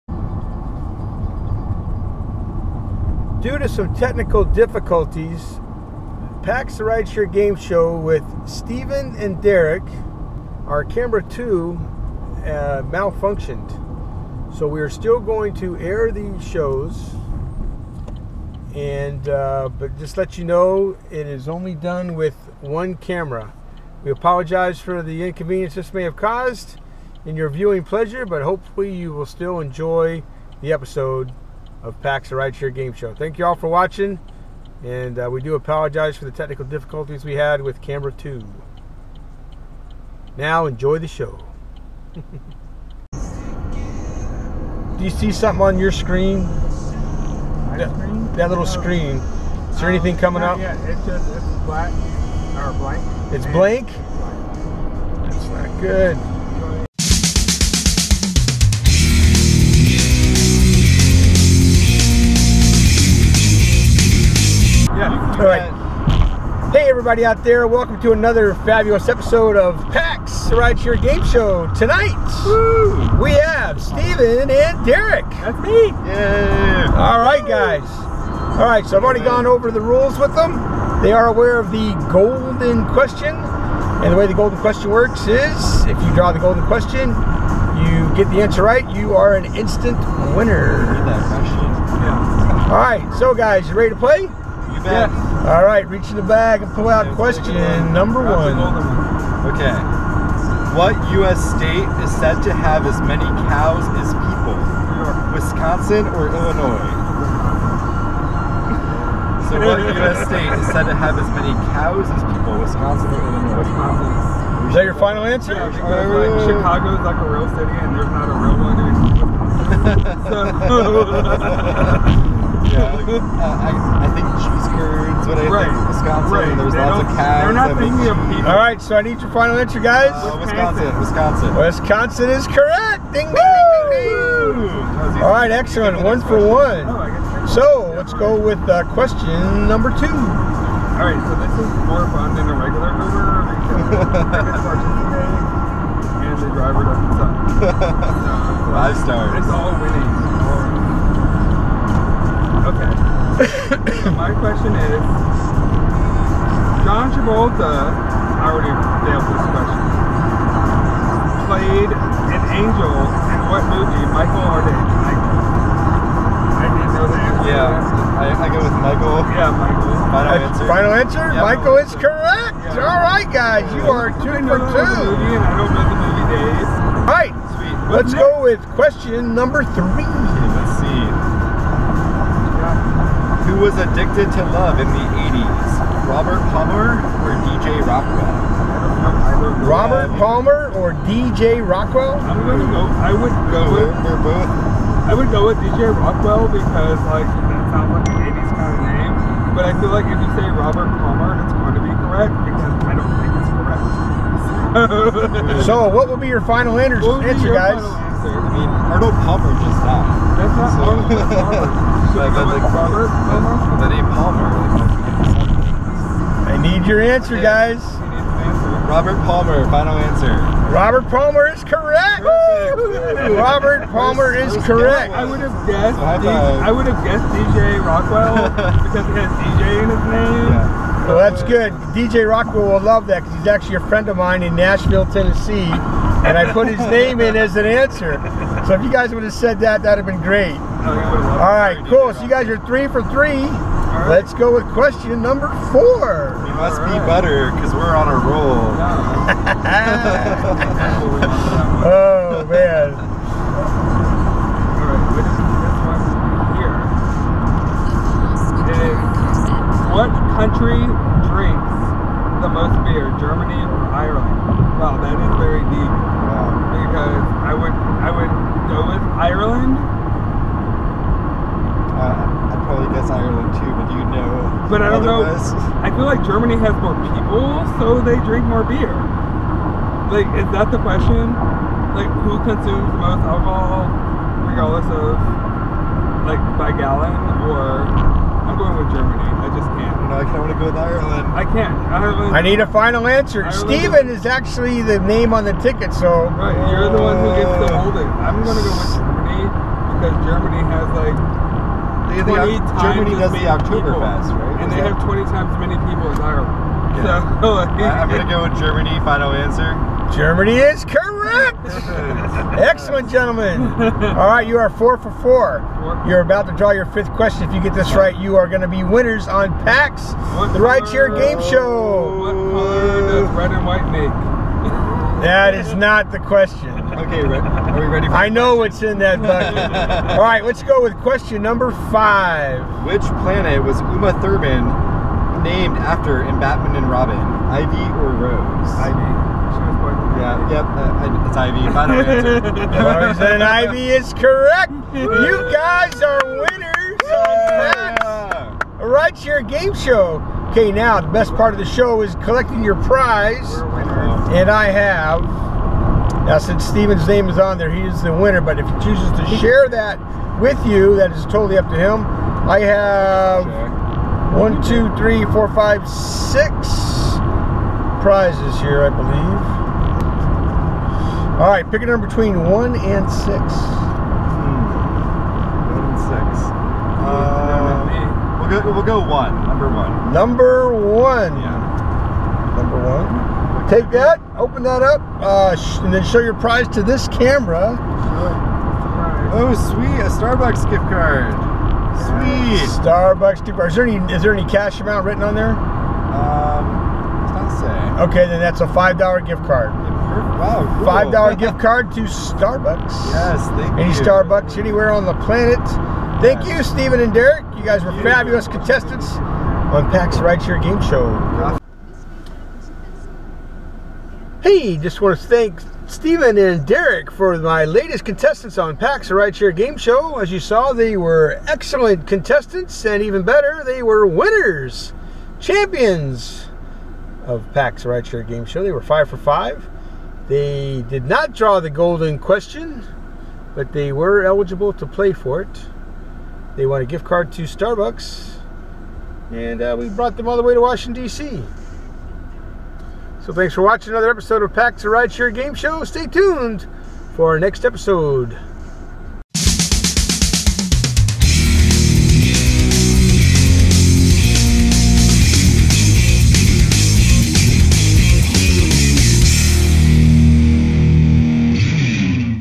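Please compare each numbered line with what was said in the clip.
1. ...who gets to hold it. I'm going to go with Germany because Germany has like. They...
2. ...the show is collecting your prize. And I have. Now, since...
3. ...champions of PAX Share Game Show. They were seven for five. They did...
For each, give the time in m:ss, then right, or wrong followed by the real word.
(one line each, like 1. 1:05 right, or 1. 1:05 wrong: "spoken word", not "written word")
1. 4:57 right
2. 5:51 right
3. 7:05 wrong: "five", not "seven".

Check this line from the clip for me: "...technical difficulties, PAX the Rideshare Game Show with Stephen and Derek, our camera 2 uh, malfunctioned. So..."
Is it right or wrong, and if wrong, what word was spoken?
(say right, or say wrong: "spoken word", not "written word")
right.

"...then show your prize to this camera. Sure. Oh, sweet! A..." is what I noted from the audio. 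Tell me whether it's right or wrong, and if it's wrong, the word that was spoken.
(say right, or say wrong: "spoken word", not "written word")
right.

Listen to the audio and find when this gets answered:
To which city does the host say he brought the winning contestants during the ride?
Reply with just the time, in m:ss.
7:20.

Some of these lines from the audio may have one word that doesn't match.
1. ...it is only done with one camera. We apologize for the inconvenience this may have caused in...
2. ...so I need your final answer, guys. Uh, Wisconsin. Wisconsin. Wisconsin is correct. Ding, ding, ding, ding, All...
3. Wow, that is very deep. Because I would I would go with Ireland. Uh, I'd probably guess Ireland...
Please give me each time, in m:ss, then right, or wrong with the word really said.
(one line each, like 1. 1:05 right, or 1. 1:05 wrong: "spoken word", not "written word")
1. 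0:21 right
2. 2:08 right
3. 4:24 right.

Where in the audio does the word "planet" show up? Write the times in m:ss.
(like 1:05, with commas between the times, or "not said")
5:33, 6:45.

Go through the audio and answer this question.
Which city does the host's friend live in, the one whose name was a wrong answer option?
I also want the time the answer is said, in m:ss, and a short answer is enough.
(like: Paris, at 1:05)
Nashville, Tennessee, at 3:54.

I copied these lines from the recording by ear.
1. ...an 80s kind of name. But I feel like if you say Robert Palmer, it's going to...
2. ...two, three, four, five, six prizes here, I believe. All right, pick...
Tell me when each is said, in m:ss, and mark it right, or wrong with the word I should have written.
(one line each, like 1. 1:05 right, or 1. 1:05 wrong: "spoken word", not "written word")
1. 3:18 right
2. 6:04 right.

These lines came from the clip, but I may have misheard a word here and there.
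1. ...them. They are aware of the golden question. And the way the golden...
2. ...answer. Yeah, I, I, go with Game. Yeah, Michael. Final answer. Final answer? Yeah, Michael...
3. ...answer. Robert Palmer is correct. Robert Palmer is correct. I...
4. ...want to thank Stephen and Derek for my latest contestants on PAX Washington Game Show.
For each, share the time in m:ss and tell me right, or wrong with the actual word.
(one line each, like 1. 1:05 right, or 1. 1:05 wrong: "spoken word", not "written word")
1. 1:20 right
2. 2:47 wrong: "Michael", not "Game"
3. 3:39 right
4. 6:55 wrong: "Share", not "Washington".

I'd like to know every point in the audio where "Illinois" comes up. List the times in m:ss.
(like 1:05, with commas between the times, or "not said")
1:46, 1:53.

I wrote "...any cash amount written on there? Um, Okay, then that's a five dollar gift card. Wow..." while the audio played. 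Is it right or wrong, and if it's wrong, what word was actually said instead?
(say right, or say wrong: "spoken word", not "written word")
right.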